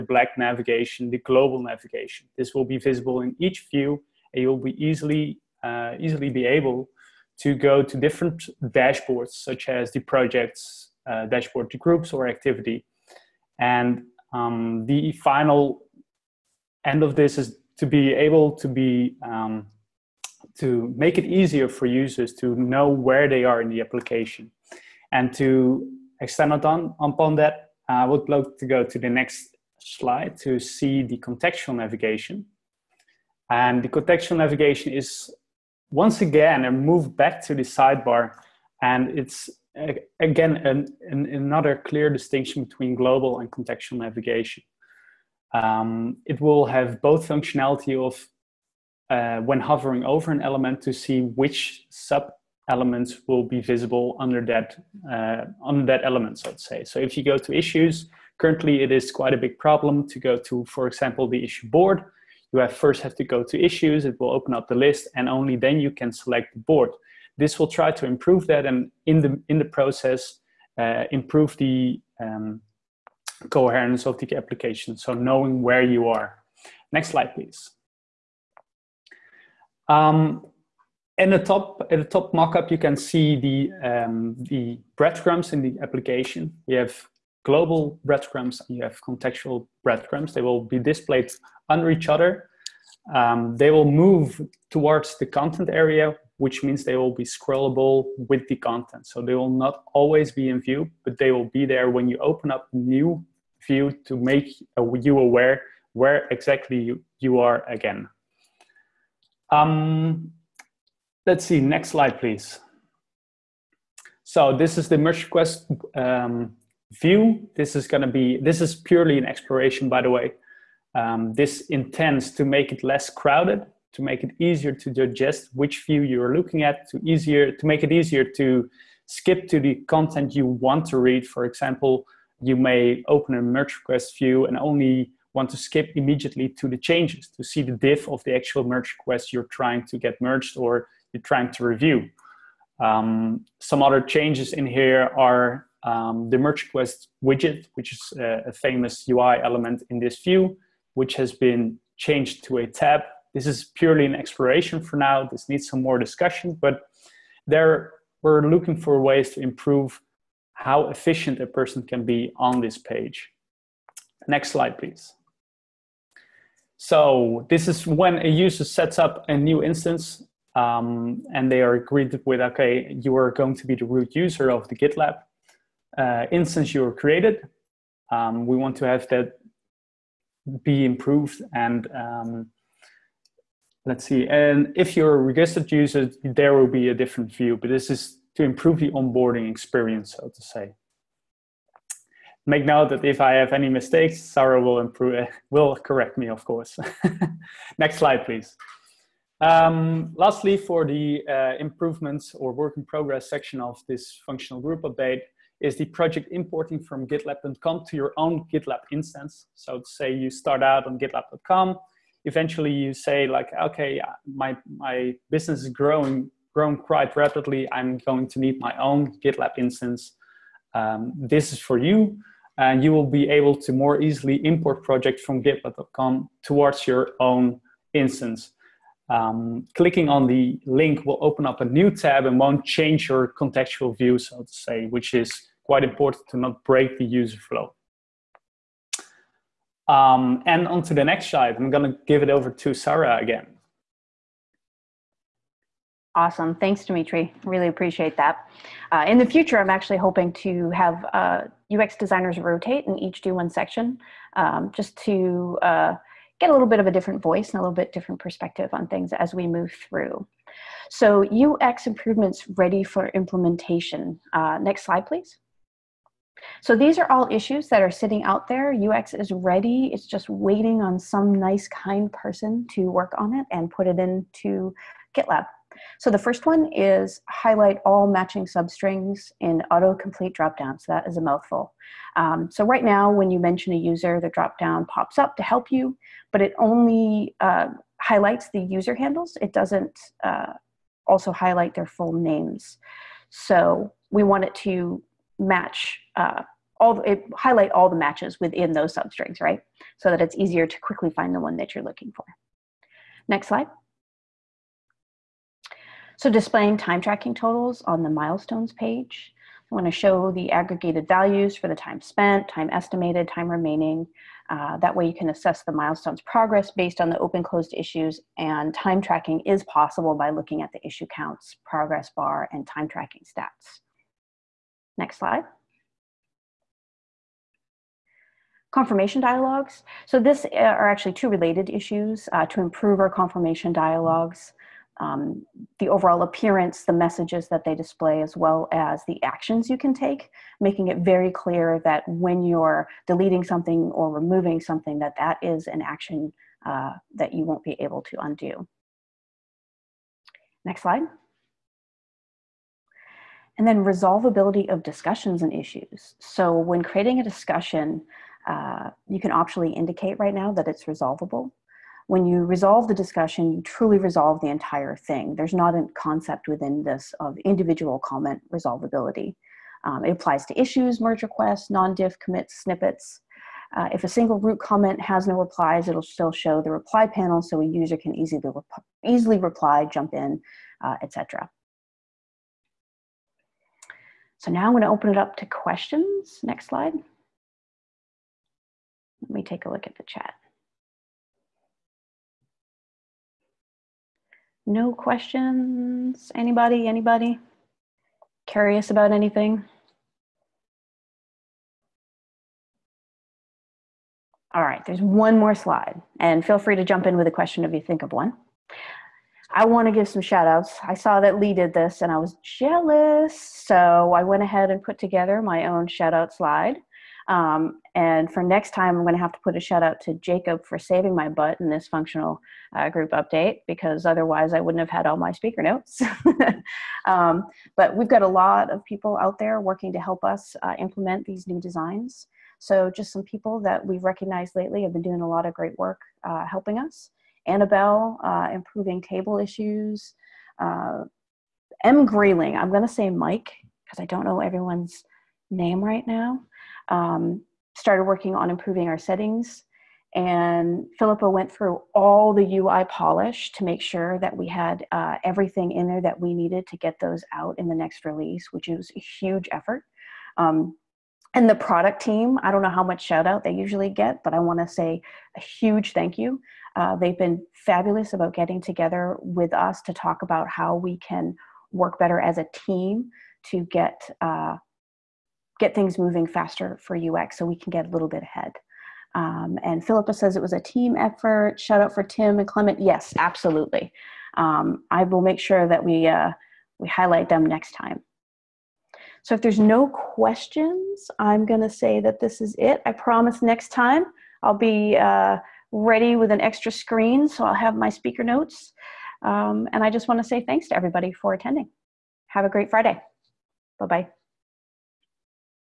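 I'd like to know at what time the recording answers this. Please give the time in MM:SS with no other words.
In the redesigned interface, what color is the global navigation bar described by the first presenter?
00:00.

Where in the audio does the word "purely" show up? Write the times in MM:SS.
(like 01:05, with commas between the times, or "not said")
01:58, 02:33.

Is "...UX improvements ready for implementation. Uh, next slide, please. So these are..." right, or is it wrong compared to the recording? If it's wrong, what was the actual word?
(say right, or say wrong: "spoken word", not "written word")
right.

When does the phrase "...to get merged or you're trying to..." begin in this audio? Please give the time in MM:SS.
02:19.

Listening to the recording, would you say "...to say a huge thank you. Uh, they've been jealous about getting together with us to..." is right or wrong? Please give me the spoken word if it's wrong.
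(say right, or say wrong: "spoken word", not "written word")
wrong: "fabulous", not "jealous".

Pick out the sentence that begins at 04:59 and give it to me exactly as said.
So that it's easier to quickly find the one that you're looking for.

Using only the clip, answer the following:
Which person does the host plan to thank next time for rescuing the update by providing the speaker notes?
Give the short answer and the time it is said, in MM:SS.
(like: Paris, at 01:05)
Jacob, at 07:00.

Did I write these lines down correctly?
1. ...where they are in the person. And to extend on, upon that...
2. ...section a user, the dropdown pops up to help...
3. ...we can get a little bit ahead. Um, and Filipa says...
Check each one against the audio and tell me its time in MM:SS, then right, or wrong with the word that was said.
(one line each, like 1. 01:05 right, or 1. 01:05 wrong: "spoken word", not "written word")
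1. 00:22 wrong: "application", not "person"
2. 04:43 wrong: "mention", not "section"
3. 07:57 right.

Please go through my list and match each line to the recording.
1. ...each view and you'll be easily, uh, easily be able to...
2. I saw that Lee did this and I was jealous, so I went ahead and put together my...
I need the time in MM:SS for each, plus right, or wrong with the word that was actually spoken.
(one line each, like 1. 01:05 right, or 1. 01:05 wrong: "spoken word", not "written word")
1. 00:03 right
2. 06:50 right.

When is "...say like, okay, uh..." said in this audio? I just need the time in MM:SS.
03:32.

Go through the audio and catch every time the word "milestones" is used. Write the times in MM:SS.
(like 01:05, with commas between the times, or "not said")
05:08, 05:15.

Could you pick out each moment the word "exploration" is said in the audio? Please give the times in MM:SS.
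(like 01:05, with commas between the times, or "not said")
01:59, 02:34.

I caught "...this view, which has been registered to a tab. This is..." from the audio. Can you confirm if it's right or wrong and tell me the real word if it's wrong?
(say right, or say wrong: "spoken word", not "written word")
wrong: "changed", not "registered".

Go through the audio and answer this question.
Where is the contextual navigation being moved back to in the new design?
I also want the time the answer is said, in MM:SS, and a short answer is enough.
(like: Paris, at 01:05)
The sidebar, at 00:37.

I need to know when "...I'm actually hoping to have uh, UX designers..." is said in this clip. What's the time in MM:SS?
04:09.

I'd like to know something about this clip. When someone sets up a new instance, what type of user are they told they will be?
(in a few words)
Root user.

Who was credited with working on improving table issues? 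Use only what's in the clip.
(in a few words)
Annabelle.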